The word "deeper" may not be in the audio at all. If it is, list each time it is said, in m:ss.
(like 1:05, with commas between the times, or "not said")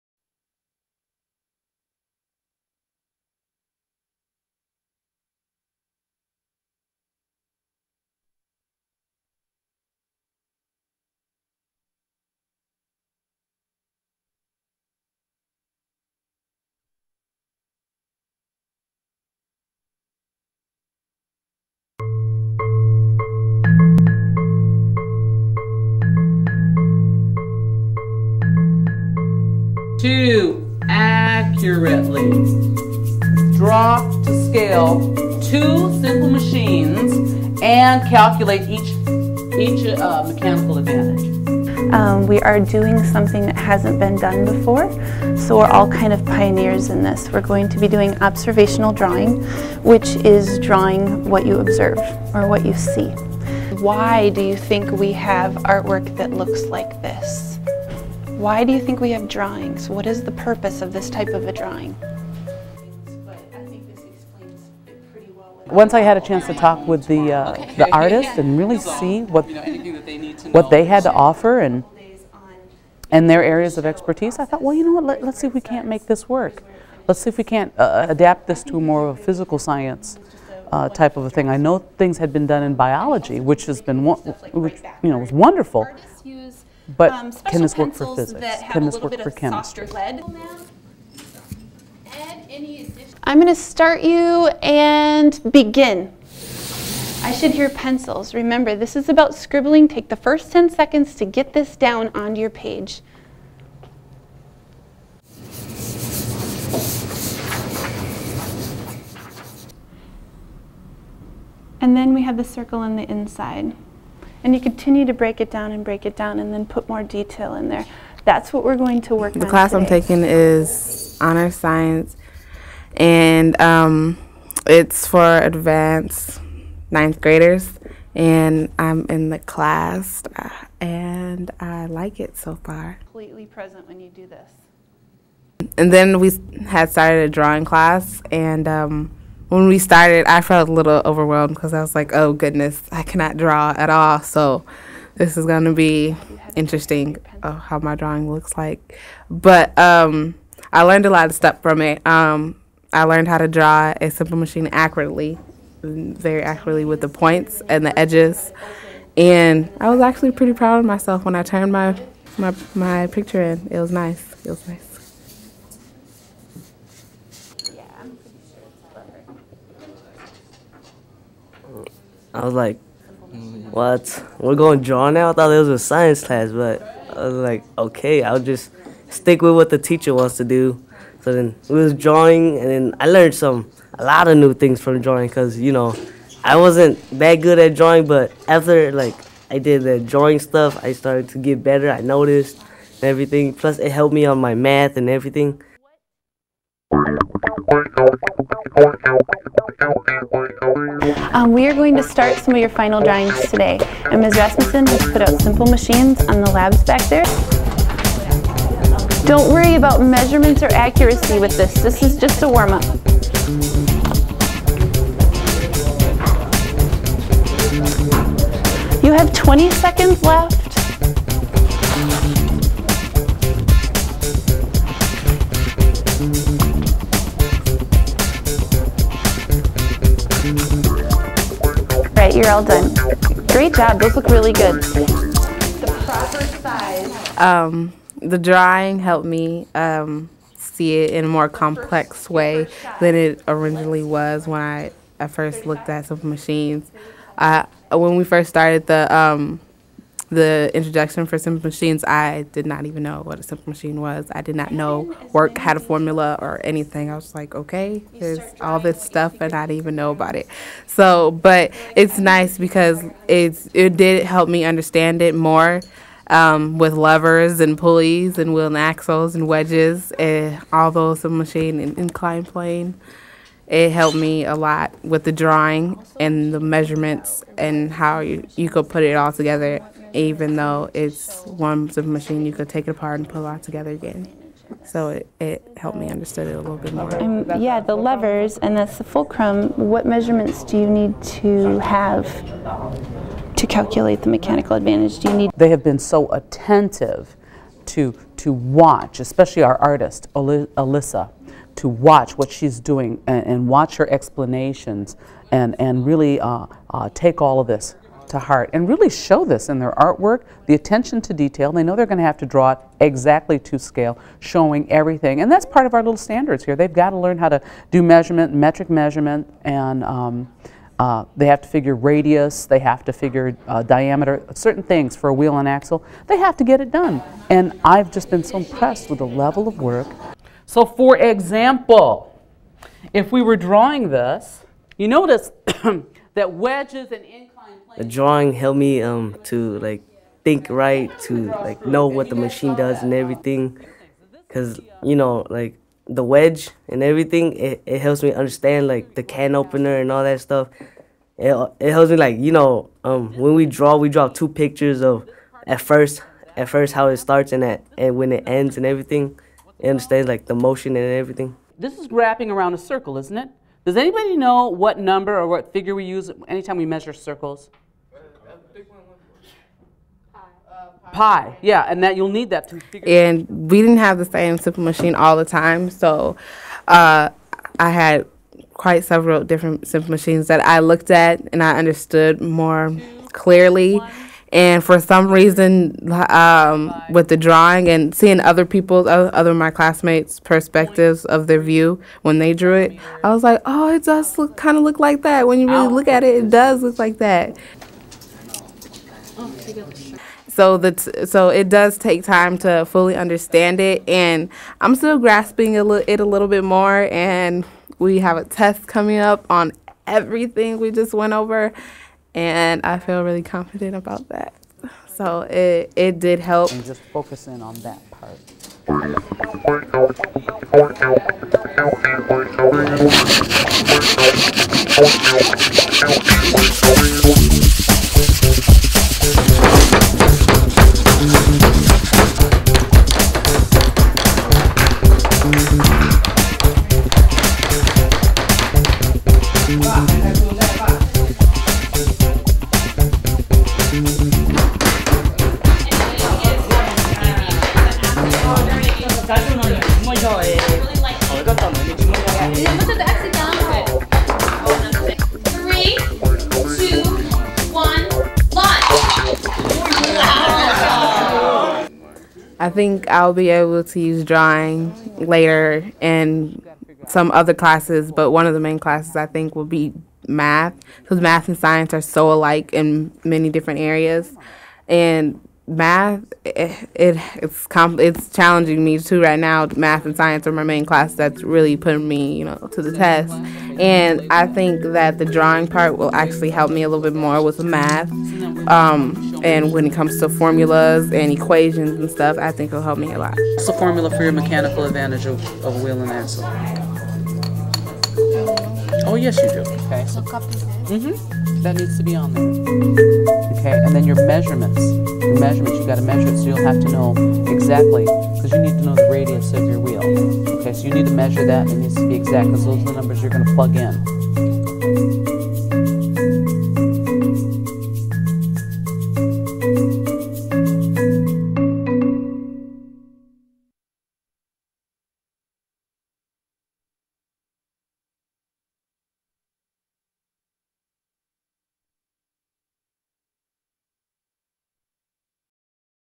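not said.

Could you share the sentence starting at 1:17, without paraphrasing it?
Let's see if we can't uh, uh, adapt this to more of a physical science uh, type of a thing.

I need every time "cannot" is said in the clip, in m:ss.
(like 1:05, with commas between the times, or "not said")
2:23.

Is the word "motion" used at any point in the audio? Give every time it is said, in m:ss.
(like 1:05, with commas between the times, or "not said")
6:00.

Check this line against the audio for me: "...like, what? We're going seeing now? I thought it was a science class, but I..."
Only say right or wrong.
wrong.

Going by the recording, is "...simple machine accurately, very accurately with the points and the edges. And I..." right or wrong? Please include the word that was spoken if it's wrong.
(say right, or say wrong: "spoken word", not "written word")
right.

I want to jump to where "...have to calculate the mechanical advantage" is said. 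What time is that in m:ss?
4:51.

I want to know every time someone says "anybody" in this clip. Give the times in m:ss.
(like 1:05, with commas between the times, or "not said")
6:03.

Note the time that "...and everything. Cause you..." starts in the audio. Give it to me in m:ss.
5:43.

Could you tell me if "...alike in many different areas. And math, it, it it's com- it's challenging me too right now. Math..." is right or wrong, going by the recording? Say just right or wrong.
right.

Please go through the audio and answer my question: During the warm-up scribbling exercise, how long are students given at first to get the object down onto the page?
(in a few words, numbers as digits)
10 seconds.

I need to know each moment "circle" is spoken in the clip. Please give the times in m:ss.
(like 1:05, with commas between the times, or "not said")
1:52, 6:02, 6:07.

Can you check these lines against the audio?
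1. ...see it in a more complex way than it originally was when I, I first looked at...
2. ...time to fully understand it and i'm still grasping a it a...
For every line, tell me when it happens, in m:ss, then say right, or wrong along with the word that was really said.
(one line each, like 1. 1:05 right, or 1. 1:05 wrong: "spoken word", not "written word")
1. 4:00 right
2. 6:42 right.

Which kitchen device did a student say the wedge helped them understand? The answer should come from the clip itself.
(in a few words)
Can opener.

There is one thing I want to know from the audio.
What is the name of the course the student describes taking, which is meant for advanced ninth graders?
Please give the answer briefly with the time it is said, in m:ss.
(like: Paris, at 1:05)
Honor science, at 2:01.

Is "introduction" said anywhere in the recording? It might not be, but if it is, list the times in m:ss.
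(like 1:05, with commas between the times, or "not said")
4:10.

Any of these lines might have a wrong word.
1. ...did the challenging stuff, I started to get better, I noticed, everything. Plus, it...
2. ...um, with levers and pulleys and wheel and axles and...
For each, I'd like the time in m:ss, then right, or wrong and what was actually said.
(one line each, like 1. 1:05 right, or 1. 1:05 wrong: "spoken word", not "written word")
1. 3:09 wrong: "drawing", not "challenging"
2. 4:26 right.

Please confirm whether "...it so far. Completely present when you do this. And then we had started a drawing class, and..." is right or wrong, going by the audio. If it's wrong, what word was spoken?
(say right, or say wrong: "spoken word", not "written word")
right.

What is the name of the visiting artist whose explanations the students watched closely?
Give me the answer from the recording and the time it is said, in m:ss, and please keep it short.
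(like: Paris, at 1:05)
Alyssa, at 5:00.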